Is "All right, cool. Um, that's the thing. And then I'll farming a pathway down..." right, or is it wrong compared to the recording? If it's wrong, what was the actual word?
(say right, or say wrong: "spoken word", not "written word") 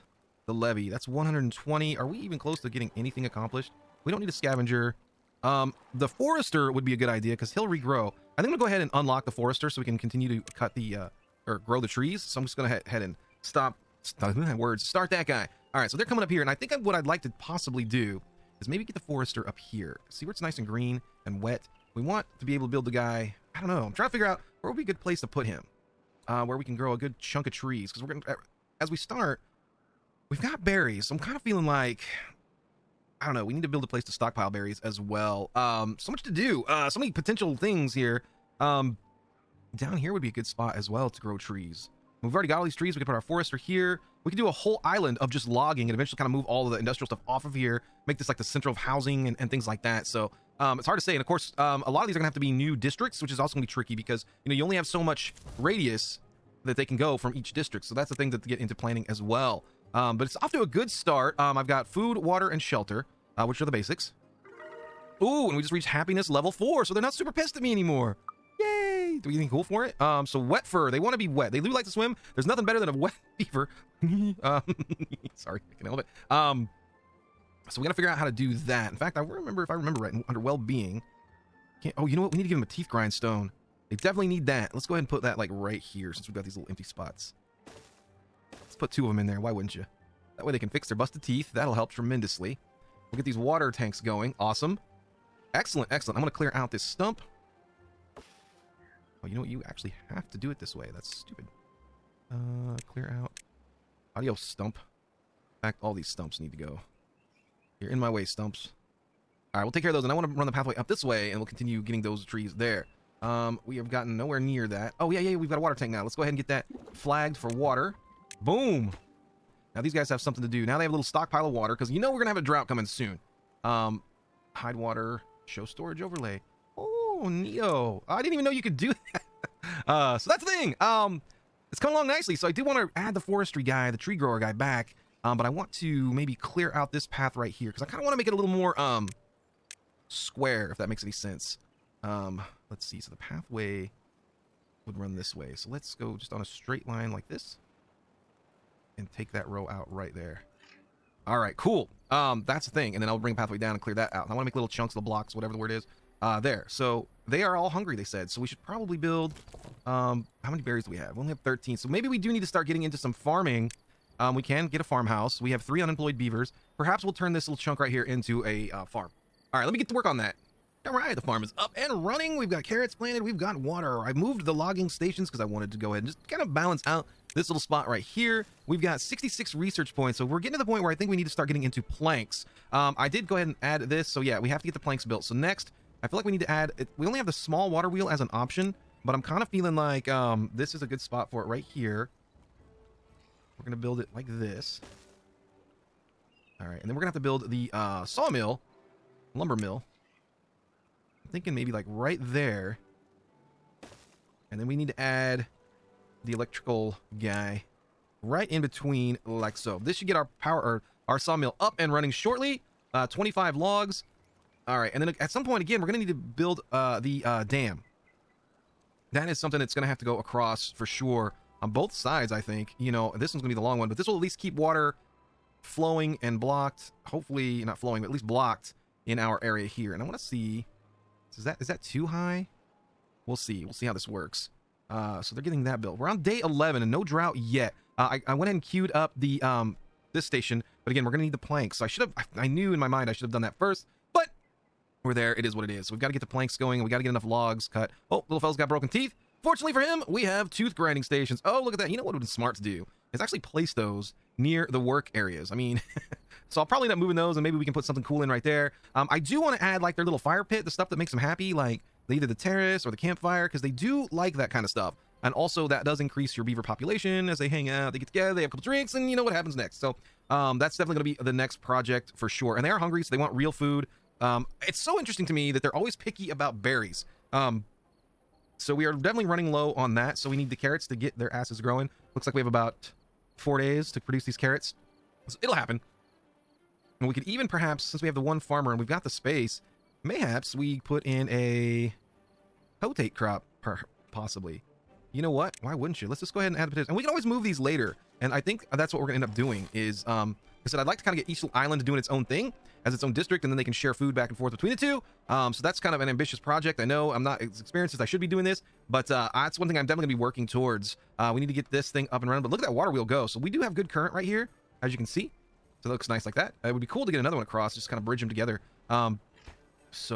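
wrong: "bring", not "farming".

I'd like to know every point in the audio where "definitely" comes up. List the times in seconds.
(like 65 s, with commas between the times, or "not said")
83 s, 270 s, 278 s, 309 s.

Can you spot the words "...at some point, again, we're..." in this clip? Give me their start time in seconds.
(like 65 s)
215 s.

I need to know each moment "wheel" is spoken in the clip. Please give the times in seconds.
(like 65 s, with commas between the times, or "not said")
187 s, 312 s.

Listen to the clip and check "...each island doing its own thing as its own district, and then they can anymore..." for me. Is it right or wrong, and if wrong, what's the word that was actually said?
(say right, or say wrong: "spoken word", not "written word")
wrong: "share", not "anymore".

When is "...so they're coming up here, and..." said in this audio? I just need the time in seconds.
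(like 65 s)
15 s.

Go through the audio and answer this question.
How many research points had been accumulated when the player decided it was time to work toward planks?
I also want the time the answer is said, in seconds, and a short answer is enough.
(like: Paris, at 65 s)
66, at 178 s.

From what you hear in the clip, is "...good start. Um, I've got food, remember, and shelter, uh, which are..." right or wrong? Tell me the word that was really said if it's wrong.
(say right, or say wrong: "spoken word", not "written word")
wrong: "water", not "remember".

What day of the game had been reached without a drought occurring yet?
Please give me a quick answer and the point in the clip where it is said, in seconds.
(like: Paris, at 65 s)
Day 11, at 236 s.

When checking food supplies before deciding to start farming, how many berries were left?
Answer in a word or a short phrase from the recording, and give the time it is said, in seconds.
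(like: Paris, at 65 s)
13, at 161 s.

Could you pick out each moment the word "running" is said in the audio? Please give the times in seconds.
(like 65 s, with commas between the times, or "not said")
172 s, 211 s, 279 s, 312 s.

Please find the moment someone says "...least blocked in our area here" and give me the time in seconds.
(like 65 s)
228 s.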